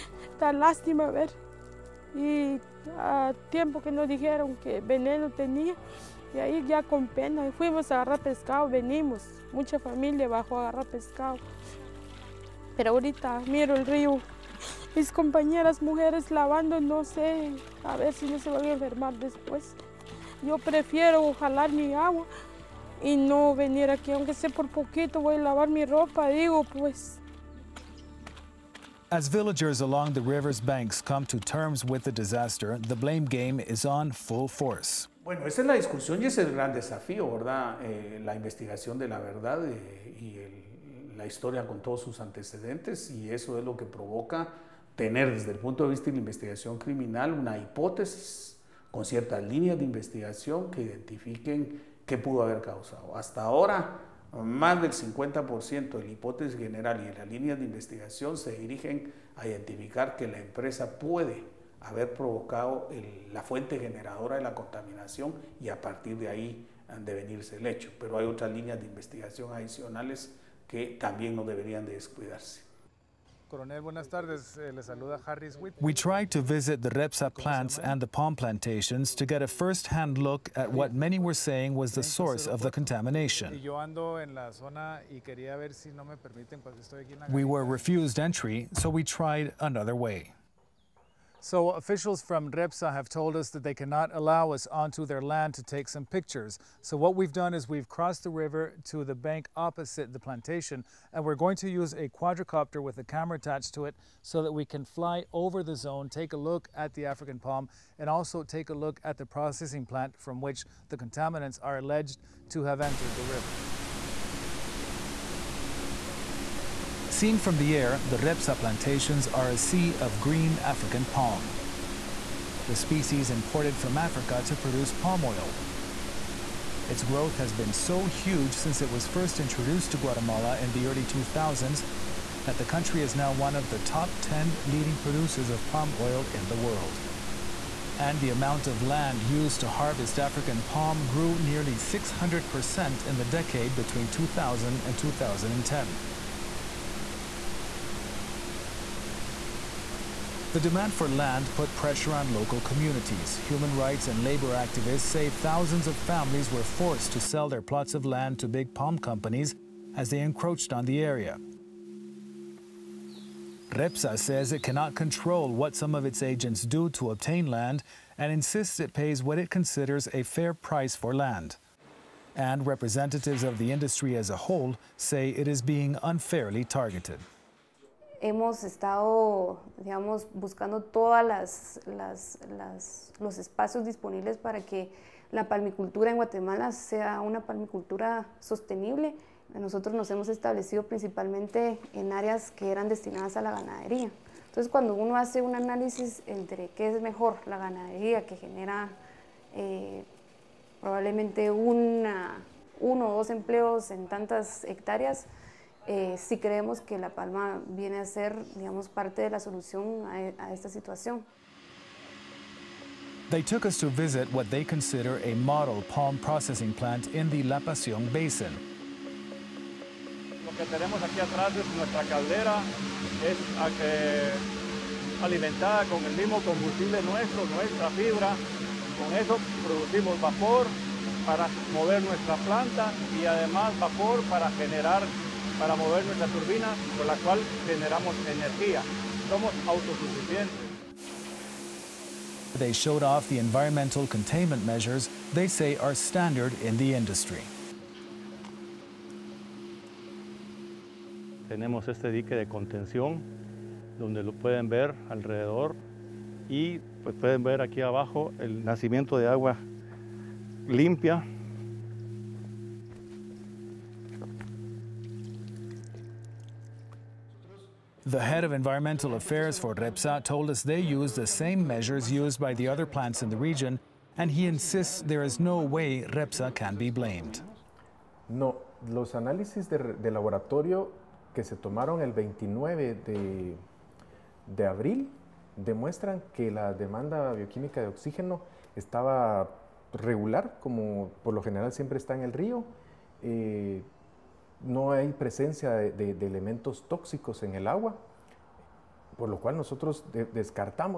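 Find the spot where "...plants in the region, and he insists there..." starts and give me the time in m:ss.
4:32.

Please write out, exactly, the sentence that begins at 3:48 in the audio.
Con eso producimos vapor para mover nuestra planta y además vapor para generar para mover nuestra turbina con la cual generamos energía.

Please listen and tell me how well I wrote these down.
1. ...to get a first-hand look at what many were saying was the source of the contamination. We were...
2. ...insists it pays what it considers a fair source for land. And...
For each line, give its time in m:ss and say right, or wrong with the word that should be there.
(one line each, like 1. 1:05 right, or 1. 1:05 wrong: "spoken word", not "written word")
1. 1:19 right
2. 2:48 wrong: "price", not "source".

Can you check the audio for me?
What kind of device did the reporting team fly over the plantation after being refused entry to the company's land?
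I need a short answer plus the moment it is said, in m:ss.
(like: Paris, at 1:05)
quadricopter, at 1:42.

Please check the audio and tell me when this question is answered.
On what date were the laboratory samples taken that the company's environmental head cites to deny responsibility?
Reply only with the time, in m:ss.
4:42.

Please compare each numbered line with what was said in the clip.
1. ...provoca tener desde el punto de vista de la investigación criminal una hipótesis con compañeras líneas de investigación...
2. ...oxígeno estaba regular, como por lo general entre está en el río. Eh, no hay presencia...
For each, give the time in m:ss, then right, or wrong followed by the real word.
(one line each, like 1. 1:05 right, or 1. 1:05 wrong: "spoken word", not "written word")
1. 0:43 wrong: "ciertas", not "compañeras"
2. 4:47 wrong: "siempre", not "entre".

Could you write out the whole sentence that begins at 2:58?
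hemos estado, buscando todos los espacios disponibles para que la palmicultura en Guatemala sea una palmicultura sostenible.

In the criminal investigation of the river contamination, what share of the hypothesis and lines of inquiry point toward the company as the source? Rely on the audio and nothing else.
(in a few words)
more than 50%.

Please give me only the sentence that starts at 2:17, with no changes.
And the amount of land used to harvest African palm grew nearly 600% in the decade between 2000 and 2010.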